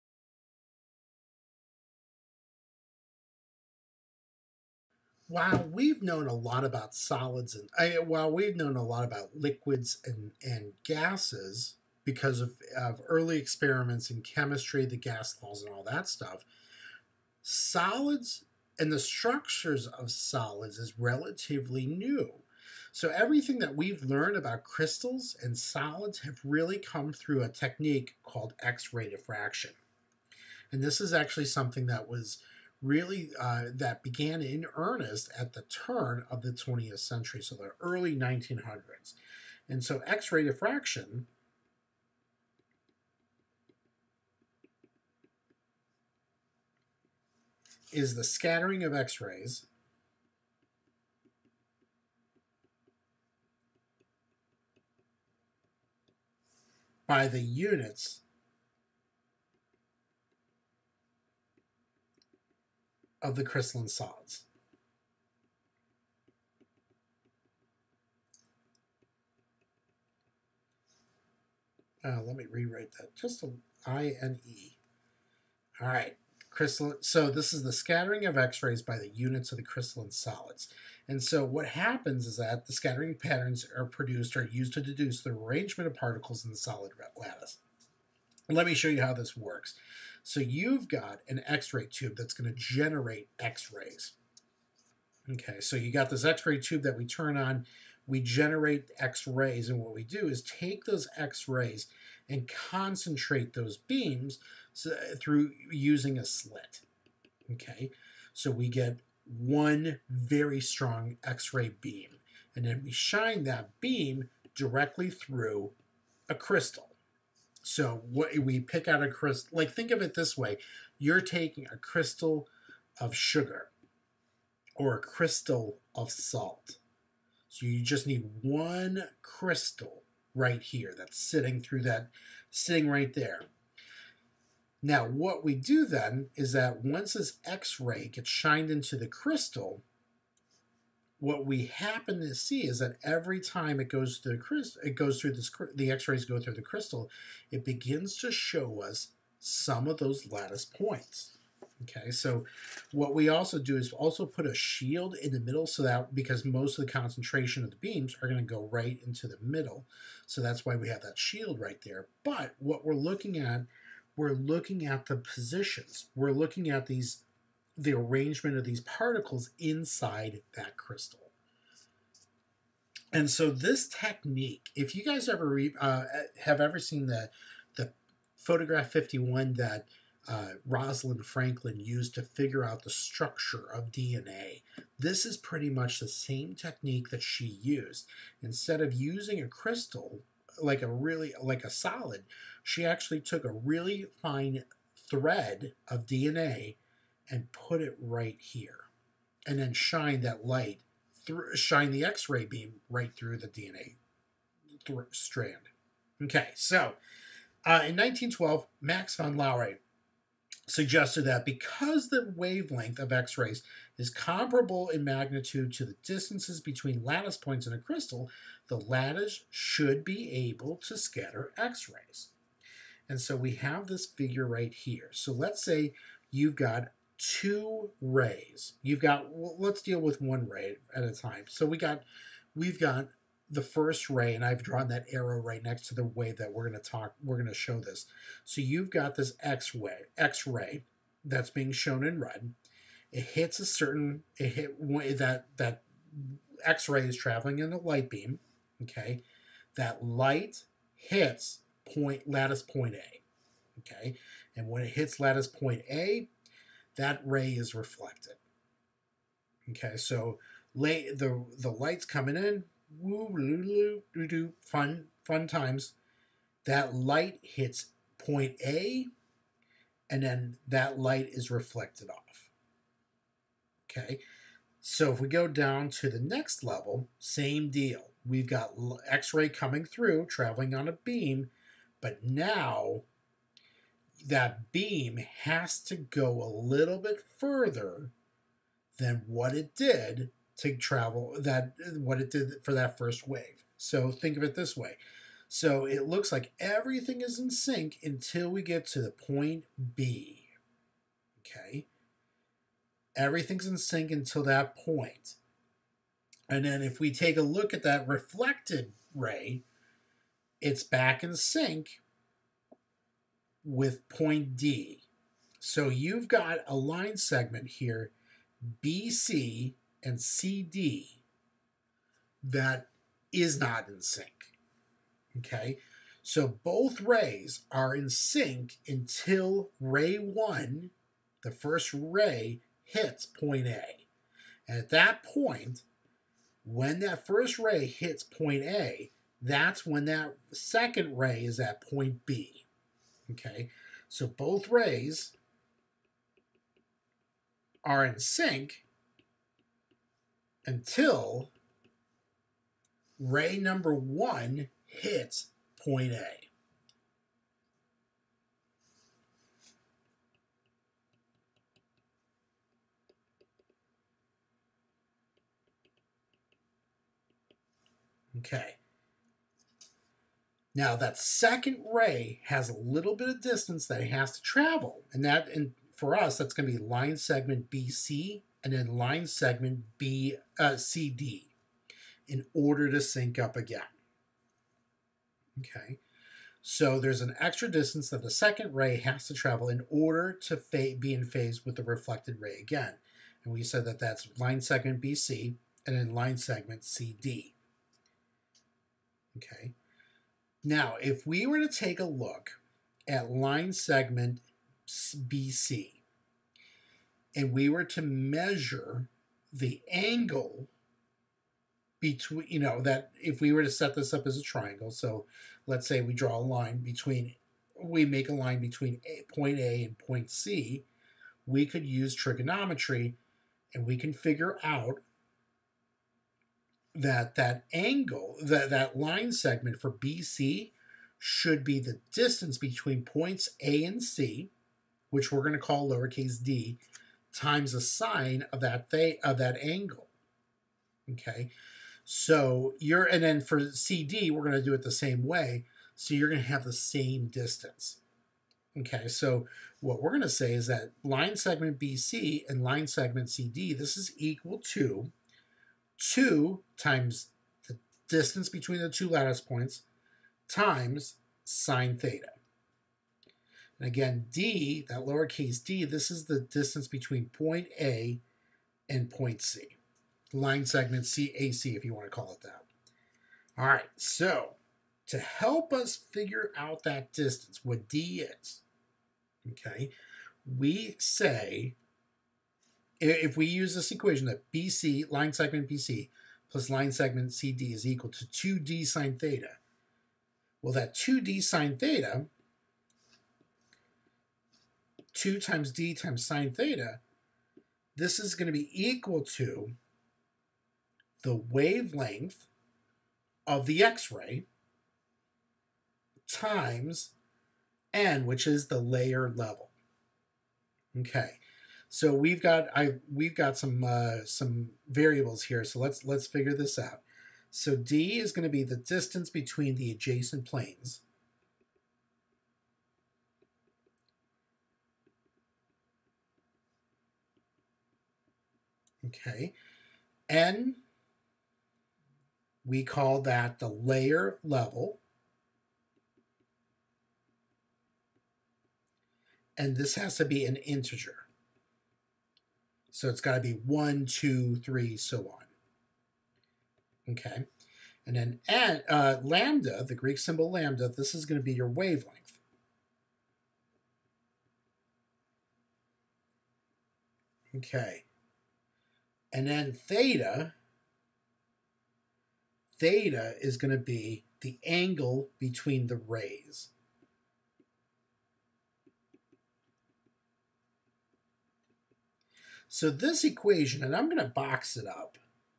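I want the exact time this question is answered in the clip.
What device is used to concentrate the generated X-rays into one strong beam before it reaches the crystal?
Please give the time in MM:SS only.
01:46.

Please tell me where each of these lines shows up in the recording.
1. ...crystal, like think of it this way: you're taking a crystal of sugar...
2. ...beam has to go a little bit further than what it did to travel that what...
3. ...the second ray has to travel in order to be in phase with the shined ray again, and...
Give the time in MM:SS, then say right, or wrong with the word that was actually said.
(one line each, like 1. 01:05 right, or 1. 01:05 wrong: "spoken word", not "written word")
1. 01:59 right
2. 04:44 right
3. 06:28 wrong: "reflected", not "shined".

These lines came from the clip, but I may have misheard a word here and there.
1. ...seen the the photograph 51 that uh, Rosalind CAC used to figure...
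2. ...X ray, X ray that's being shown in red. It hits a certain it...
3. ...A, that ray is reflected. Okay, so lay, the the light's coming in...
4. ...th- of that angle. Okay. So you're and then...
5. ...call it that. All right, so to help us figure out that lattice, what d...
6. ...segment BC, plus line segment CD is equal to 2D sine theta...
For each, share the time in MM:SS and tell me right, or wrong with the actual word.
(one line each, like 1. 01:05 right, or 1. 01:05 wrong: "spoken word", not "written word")
1. 02:56 wrong: "Franklin", not "CAC"
2. 03:59 right
3. 04:15 right
4. 07:18 right
5. 07:52 wrong: "distance", not "lattice"
6. 08:05 right.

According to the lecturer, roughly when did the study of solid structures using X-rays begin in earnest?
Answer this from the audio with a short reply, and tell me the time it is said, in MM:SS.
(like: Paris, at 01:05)
early 1900s, at 00:37.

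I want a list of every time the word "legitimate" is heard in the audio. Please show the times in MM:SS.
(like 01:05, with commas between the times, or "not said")
not said.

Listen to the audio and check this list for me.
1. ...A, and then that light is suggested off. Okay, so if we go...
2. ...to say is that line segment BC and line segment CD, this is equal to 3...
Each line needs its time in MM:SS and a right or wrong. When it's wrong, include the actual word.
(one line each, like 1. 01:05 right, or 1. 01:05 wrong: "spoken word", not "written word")
1. 04:28 wrong: "reflected", not "suggested"
2. 07:30 wrong: "2", not "3".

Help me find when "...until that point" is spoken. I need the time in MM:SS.
05:04.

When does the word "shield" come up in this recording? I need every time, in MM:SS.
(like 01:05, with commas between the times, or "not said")
02:34, 02:41.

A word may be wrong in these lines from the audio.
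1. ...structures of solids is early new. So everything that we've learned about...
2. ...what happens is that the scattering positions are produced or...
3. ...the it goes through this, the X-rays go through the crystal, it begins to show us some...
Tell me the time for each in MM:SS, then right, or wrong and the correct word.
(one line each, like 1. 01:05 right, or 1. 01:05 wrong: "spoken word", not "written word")
1. 00:18 wrong: "relatively", not "early"
2. 01:21 wrong: "patterns", not "positions"
3. 02:24 right.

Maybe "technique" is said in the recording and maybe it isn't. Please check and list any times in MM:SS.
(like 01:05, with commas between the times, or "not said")
00:27, 02:53, 03:06.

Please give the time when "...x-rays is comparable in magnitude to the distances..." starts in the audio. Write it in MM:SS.
03:33.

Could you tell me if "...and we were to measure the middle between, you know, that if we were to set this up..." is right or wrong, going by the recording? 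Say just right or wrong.
wrong.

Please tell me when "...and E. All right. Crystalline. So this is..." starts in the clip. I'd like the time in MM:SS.
01:14.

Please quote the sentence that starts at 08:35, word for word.
So let's let's figure this out.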